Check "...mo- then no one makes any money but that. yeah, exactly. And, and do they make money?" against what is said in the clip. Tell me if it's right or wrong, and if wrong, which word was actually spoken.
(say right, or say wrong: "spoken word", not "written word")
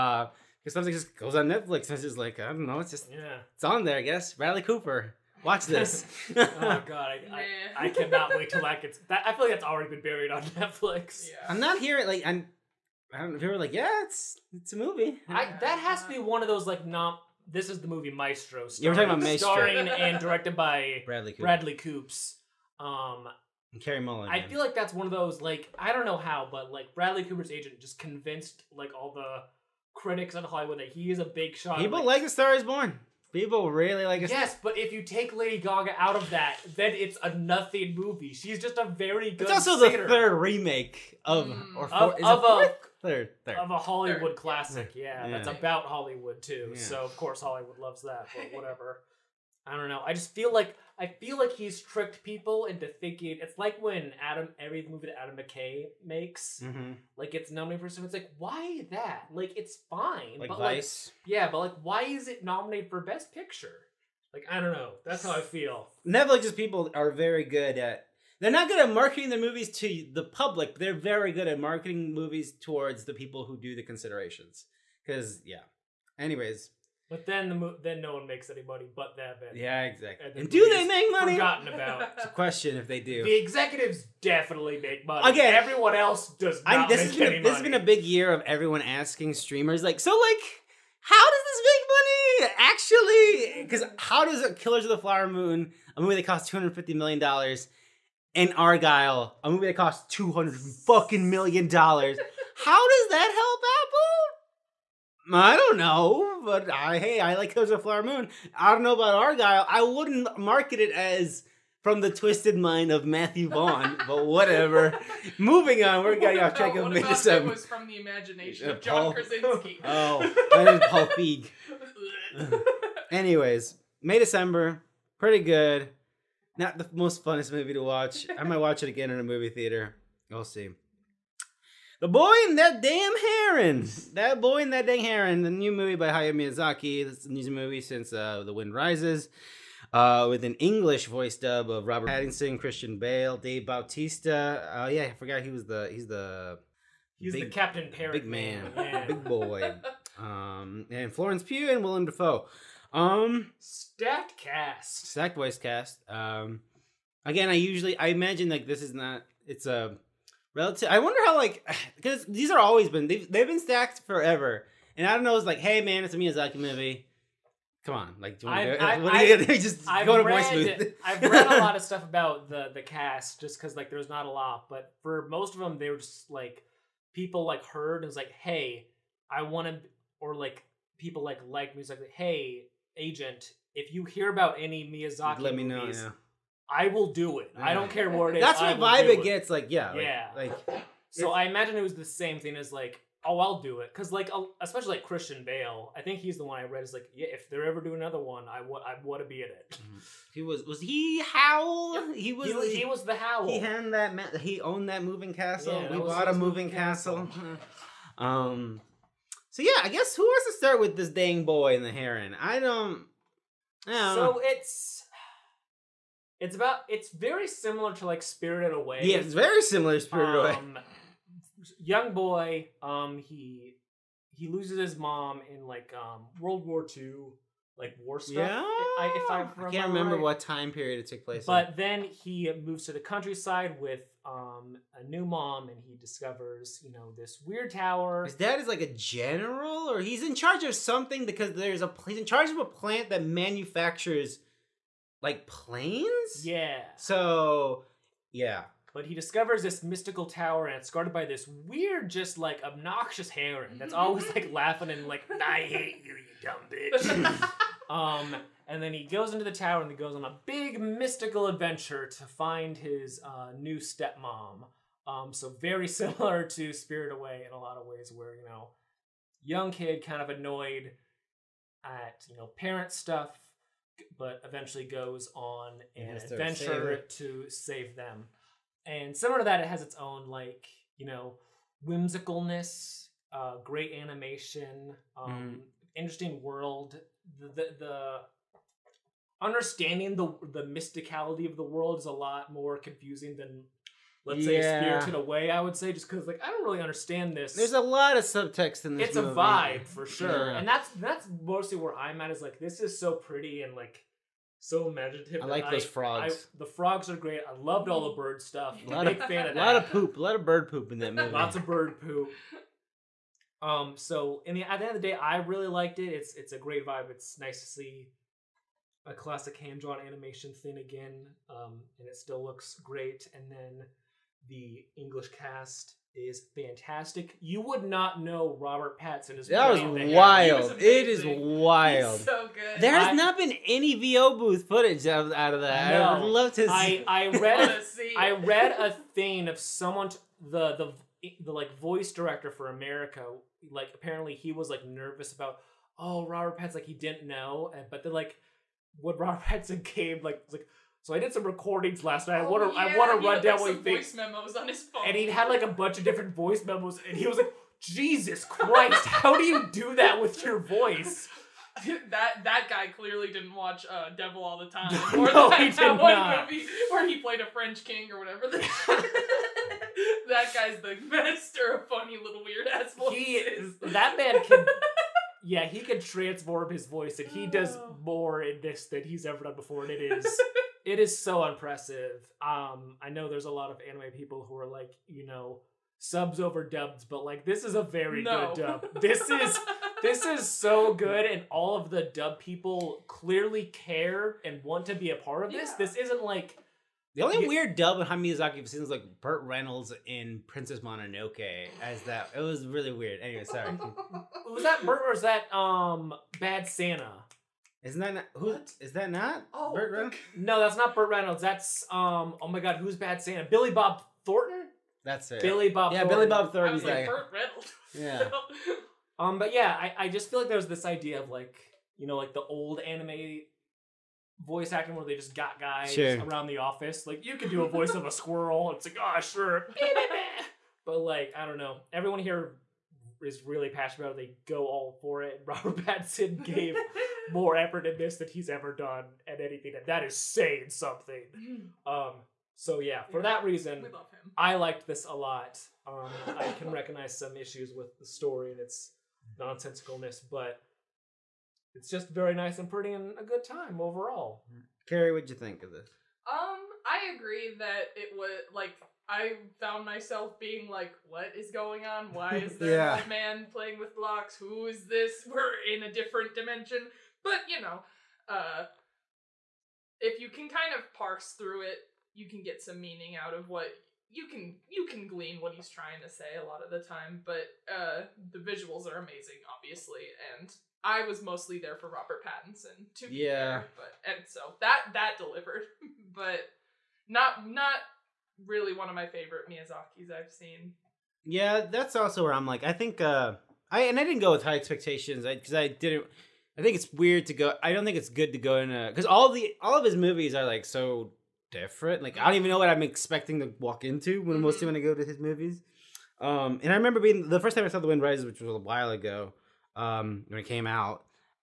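right.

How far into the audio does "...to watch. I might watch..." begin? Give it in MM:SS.
02:07.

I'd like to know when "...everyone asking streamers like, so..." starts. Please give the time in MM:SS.
01:28.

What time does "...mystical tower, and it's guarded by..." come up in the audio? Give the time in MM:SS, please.
04:09.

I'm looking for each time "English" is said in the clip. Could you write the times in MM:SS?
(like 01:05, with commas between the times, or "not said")
02:20, 05:24.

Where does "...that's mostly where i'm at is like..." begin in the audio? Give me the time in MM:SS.
05:00.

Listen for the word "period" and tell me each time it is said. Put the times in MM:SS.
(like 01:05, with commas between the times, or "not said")
03:50.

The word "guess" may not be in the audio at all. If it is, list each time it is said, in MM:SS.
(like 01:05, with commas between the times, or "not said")
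00:04, 03:29.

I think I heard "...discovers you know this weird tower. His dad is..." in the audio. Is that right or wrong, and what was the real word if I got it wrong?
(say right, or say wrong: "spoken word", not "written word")
right.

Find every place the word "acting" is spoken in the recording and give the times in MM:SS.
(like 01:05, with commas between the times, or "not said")
07:04.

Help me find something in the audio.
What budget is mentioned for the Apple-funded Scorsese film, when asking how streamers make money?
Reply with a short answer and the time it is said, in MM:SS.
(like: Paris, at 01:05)
250 million dollars, at 01:36.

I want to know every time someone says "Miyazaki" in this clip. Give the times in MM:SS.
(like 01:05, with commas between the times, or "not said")
02:16, 02:46, 03:04, 06:38, 08:09.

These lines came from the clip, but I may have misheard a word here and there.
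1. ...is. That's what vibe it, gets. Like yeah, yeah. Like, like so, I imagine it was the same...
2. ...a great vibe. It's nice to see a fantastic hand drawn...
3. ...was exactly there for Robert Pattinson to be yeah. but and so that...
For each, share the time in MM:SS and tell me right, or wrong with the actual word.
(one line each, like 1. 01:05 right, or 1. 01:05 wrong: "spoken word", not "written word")
1. 03:08 right
2. 05:16 wrong: "classic", not "fantastic"
3. 08:01 wrong: "mostly", not "exactly".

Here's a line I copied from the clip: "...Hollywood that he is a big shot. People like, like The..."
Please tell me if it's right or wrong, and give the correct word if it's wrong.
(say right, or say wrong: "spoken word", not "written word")
right.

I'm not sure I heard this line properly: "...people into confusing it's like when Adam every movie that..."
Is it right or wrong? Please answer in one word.
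wrong.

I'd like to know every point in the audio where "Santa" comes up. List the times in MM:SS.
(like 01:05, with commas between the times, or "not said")
06:46, 06:53.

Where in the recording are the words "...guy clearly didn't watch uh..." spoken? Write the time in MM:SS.
06:02.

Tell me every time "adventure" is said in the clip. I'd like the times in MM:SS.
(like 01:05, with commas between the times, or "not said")
04:21, 04:36.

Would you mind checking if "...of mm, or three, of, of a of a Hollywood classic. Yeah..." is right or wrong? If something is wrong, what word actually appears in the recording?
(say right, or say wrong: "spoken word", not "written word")
wrong: "four", not "three".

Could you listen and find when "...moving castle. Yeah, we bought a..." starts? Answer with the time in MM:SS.
03:25.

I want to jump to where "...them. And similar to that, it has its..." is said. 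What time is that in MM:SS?
04:37.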